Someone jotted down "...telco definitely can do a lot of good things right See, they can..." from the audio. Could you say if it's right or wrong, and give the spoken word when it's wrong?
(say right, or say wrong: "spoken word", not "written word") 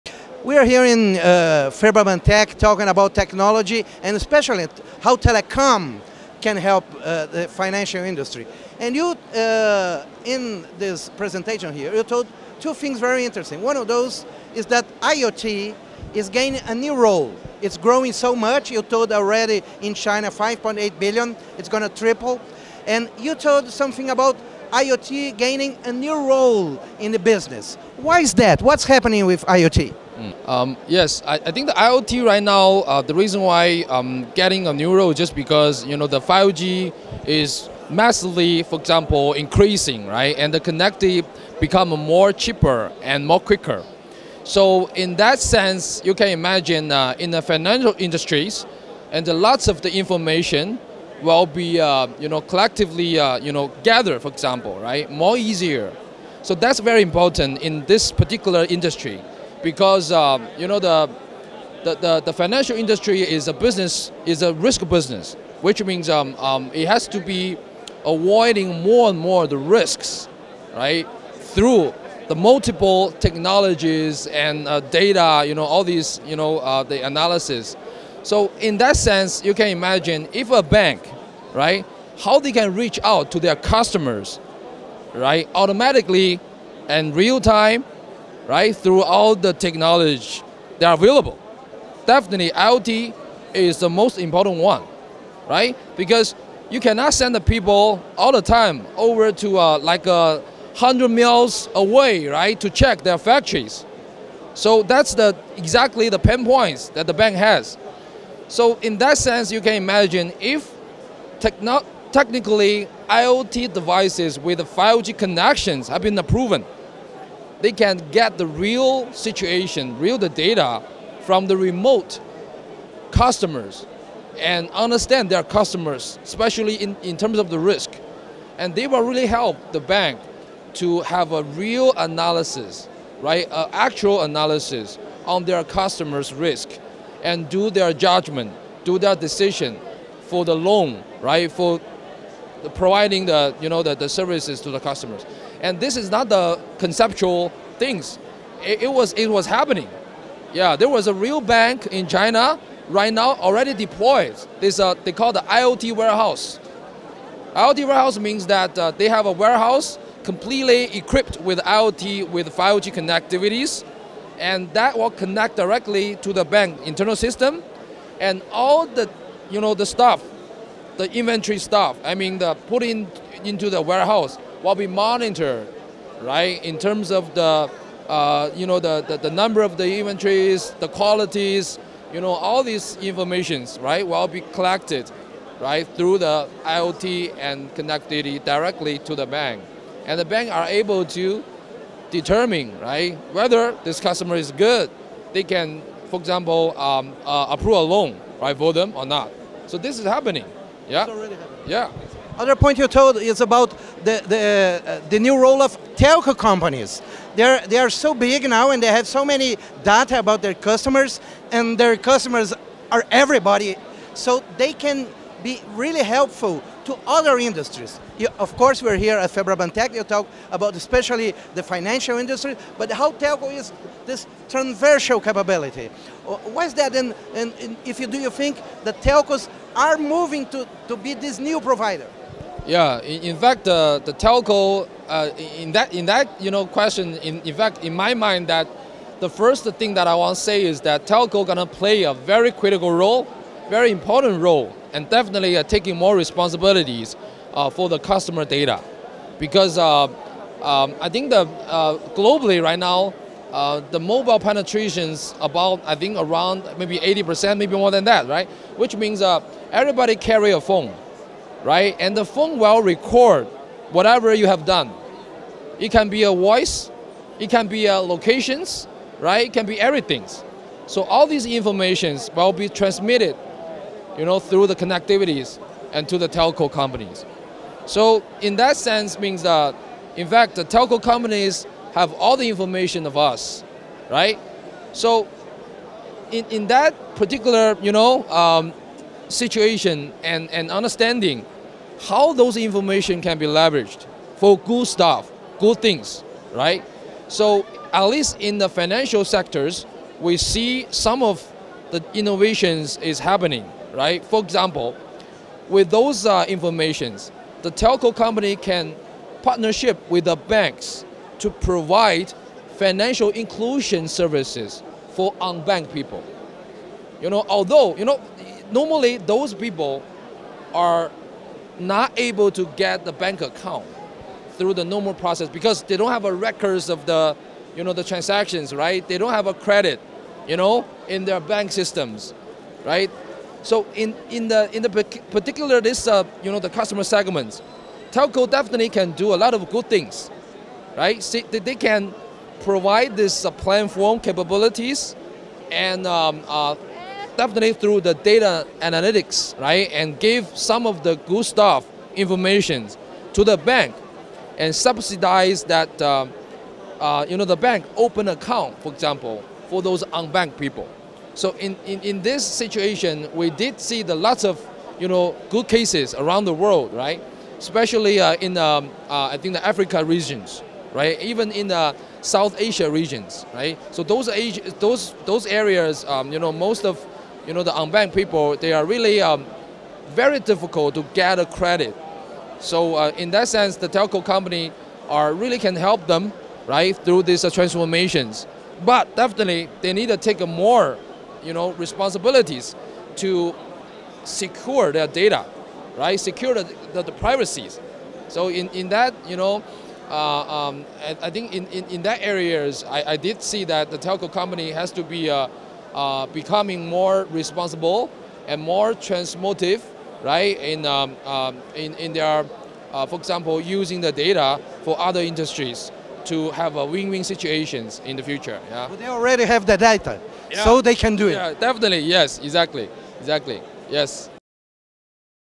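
right.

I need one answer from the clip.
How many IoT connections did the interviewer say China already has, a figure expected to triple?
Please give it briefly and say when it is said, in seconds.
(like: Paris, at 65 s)
5.8 billion, at 20 s.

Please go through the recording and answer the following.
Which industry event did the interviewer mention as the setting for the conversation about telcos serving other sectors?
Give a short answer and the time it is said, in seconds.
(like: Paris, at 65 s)
Febraban Tech, at 219 s.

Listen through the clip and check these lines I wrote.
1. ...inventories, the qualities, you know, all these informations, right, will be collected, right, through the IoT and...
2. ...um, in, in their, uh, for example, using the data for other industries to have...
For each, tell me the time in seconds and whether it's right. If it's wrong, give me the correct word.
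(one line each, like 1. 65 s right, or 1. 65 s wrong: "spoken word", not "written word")
1. 179 s right
2. 411 s right.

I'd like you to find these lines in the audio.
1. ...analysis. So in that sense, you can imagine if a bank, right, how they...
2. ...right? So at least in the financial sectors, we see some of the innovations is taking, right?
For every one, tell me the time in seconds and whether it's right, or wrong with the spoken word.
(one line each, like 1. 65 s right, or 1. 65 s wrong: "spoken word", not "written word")
1. 77 s right
2. 296 s wrong: "happening", not "taking".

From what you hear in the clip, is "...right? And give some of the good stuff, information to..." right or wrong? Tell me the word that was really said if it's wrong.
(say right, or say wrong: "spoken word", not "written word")
right.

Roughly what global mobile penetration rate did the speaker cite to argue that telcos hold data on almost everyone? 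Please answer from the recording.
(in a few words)
80 percent.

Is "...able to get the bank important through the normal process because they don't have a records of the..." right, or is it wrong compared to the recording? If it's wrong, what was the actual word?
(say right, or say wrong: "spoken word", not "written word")
wrong: "account", not "important".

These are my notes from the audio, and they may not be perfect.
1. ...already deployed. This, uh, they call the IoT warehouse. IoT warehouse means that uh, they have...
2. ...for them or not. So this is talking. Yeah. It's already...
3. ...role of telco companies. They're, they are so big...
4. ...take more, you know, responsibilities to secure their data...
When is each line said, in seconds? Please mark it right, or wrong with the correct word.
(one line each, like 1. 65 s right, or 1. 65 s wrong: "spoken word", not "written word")
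1. 153 s right
2. 198 s wrong: "happening", not "talking"
3. 205 s right
4. 390 s right.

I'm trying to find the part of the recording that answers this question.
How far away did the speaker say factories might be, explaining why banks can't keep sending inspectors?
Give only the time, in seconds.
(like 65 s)
100 s.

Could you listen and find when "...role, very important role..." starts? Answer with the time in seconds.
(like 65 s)
242 s.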